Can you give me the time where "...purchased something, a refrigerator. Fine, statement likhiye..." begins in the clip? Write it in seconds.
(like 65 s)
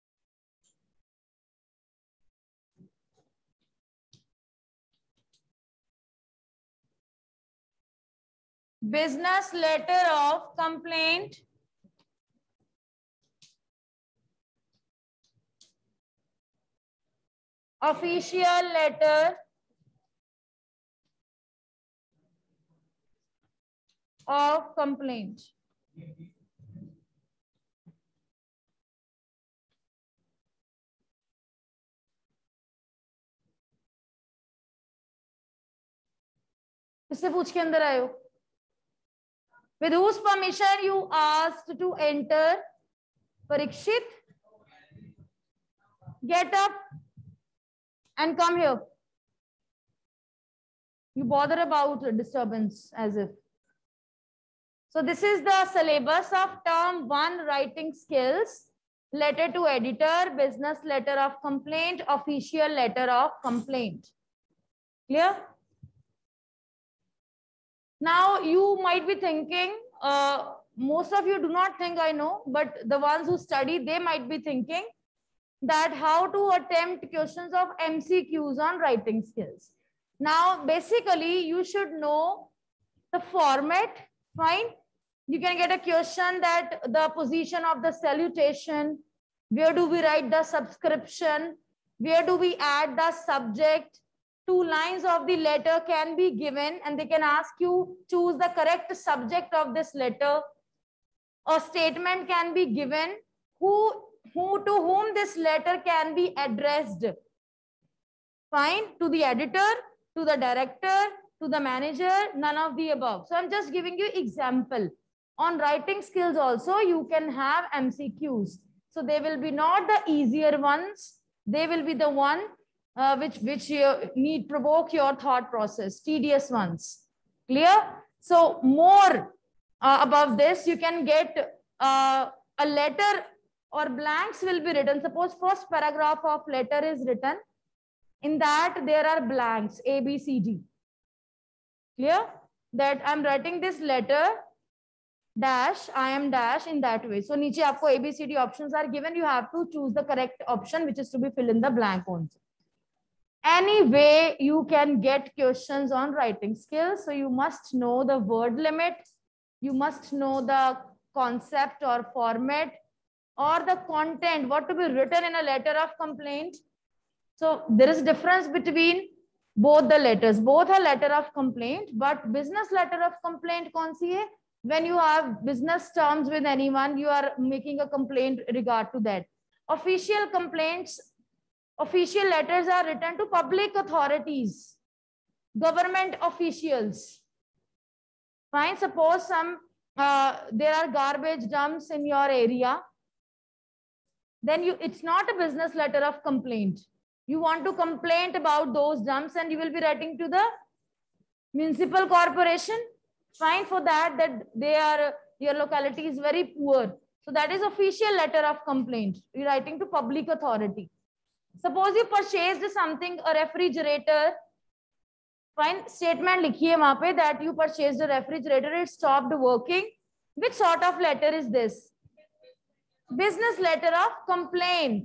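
212 s.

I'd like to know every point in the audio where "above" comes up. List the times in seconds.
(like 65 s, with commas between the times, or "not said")
112 s, 130 s.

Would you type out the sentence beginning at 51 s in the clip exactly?
You bother about disturbance as if.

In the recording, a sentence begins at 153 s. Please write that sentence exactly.
Any way you can get questions on writing skills.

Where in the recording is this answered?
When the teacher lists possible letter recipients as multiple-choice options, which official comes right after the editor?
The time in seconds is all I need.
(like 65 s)
110 s.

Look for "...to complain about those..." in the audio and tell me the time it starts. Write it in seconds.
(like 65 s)
197 s.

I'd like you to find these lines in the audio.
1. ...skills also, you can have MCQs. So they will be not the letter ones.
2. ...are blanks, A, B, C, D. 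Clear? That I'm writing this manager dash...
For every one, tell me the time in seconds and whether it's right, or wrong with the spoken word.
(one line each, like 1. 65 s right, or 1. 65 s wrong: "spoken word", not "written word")
1. 116 s wrong: "easier", not "letter"
2. 139 s wrong: "letter", not "manager".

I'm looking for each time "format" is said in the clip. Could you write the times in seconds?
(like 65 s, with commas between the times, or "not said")
83 s, 162 s.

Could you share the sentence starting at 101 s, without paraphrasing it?
A statement can be given who who to whom this letter can be addressed.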